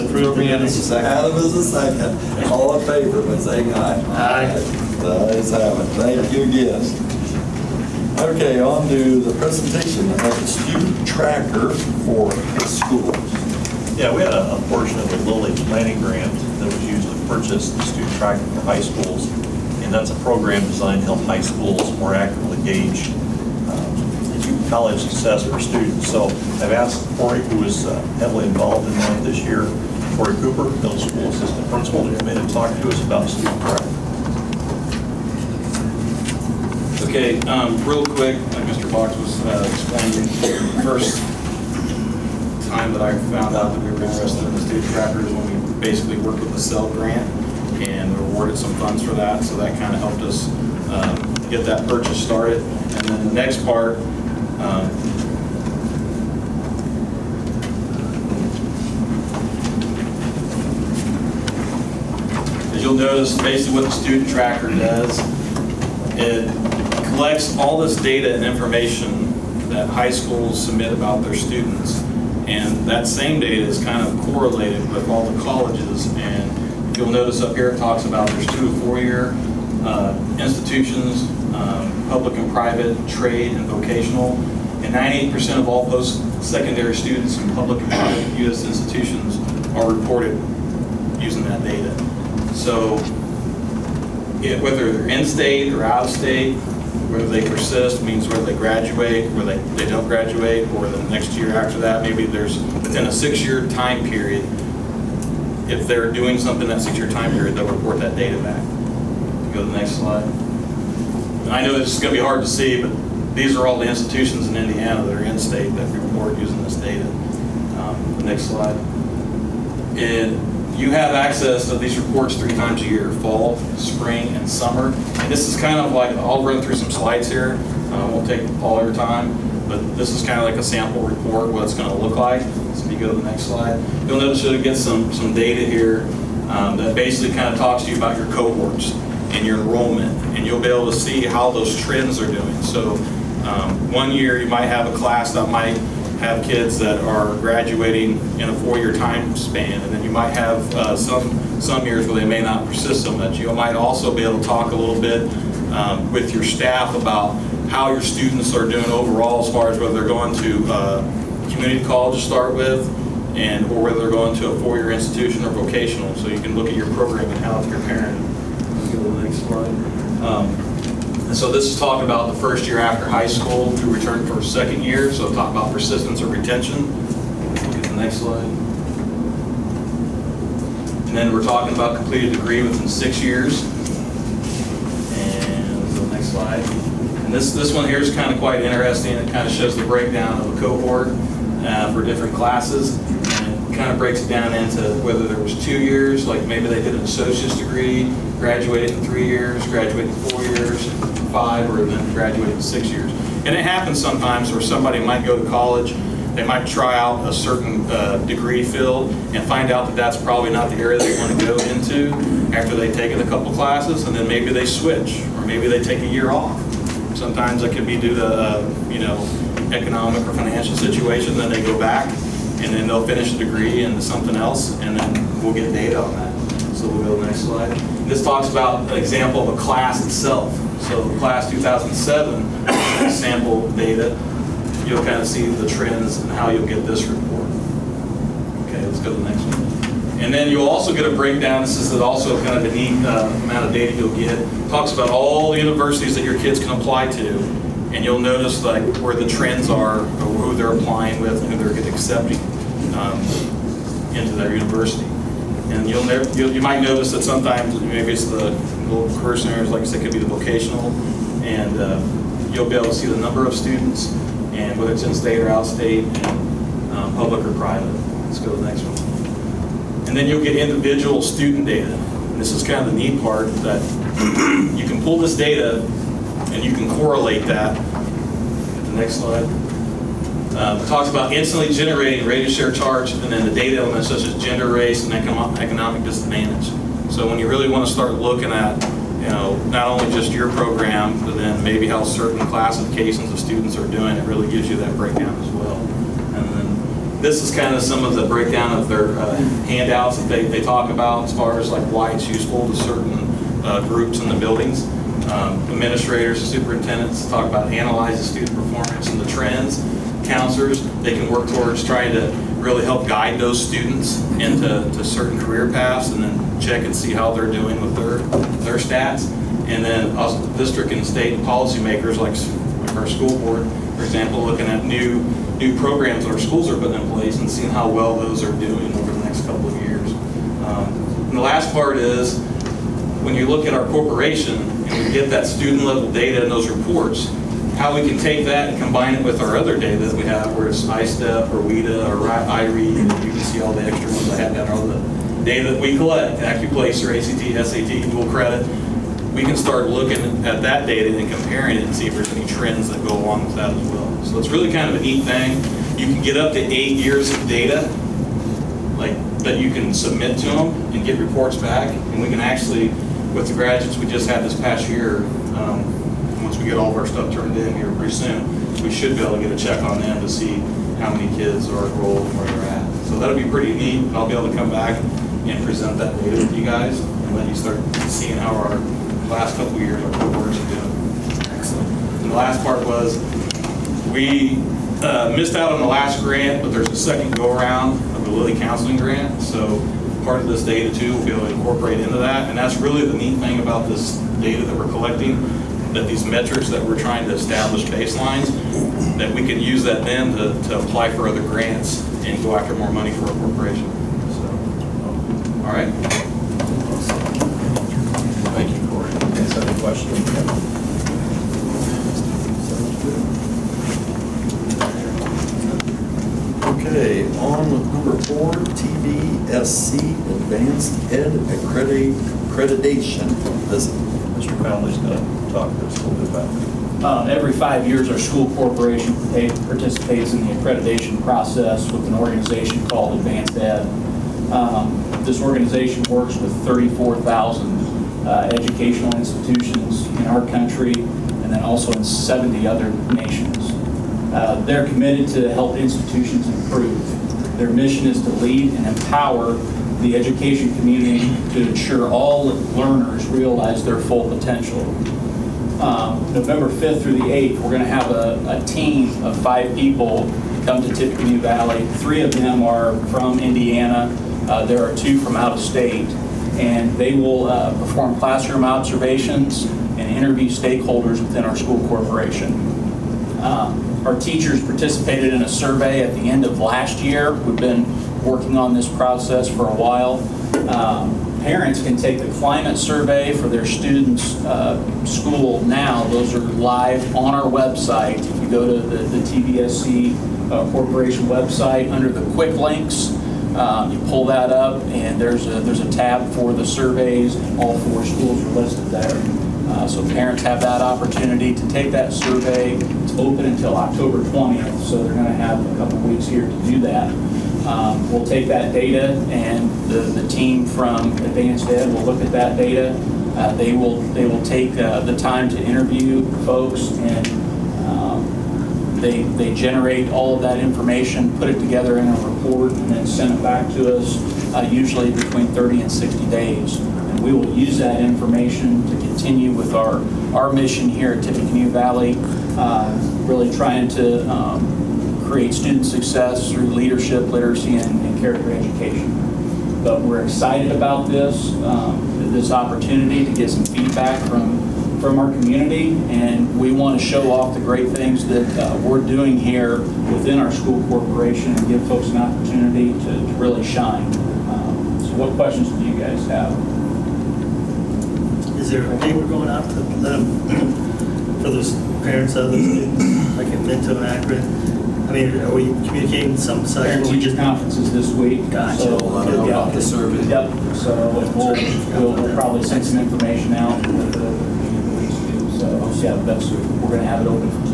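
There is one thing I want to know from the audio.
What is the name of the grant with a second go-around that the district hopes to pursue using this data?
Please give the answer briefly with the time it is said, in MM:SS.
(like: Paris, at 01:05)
Lilly Counseling Grant, at 06:28.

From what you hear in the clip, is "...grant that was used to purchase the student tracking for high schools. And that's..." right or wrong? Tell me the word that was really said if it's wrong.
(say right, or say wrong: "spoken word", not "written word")
right.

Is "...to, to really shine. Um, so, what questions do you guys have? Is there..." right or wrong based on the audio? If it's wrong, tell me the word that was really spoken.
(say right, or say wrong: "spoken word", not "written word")
right.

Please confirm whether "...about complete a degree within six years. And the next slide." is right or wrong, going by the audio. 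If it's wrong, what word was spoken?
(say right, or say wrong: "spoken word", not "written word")
right.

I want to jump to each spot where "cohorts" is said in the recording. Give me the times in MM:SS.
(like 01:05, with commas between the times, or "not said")
02:18, 03:10, 06:20.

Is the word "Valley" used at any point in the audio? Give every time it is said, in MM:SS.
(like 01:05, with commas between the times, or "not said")
07:41, 08:51.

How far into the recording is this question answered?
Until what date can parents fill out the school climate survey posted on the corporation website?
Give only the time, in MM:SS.
08:23.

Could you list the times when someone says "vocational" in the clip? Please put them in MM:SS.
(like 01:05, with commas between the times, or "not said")
01:23, 02:45, 04:20.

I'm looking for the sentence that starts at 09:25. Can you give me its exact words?
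mean, are we communicating some such?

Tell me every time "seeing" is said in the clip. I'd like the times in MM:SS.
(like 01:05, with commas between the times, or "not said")
05:27, 06:18.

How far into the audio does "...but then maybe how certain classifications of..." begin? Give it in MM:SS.
04:51.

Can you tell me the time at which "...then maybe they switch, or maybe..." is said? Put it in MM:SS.
03:34.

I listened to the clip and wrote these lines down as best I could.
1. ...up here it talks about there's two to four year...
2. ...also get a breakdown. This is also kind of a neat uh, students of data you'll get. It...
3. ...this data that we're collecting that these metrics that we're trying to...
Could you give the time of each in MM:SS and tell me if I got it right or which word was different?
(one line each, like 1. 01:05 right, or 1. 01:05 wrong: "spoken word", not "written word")
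1. 01:17 right
2. 04:00 wrong: "amount", not "students"
3. 06:33 right.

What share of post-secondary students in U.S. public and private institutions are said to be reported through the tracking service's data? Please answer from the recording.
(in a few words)
98%.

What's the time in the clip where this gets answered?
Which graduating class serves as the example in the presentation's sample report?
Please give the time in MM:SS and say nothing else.
03:51.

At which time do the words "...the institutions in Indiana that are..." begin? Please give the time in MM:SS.
01:53.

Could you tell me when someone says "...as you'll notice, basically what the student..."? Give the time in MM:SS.
01:02.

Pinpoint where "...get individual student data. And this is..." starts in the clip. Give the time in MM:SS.
04:30.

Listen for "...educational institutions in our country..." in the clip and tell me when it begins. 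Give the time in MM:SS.
07:18.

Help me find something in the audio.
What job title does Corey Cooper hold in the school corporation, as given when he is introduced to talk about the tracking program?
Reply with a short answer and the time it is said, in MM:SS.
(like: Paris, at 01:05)
middle school assistant principal, at 00:30.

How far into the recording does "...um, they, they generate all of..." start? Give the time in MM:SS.
08:37.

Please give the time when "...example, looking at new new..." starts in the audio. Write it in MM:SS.
05:24.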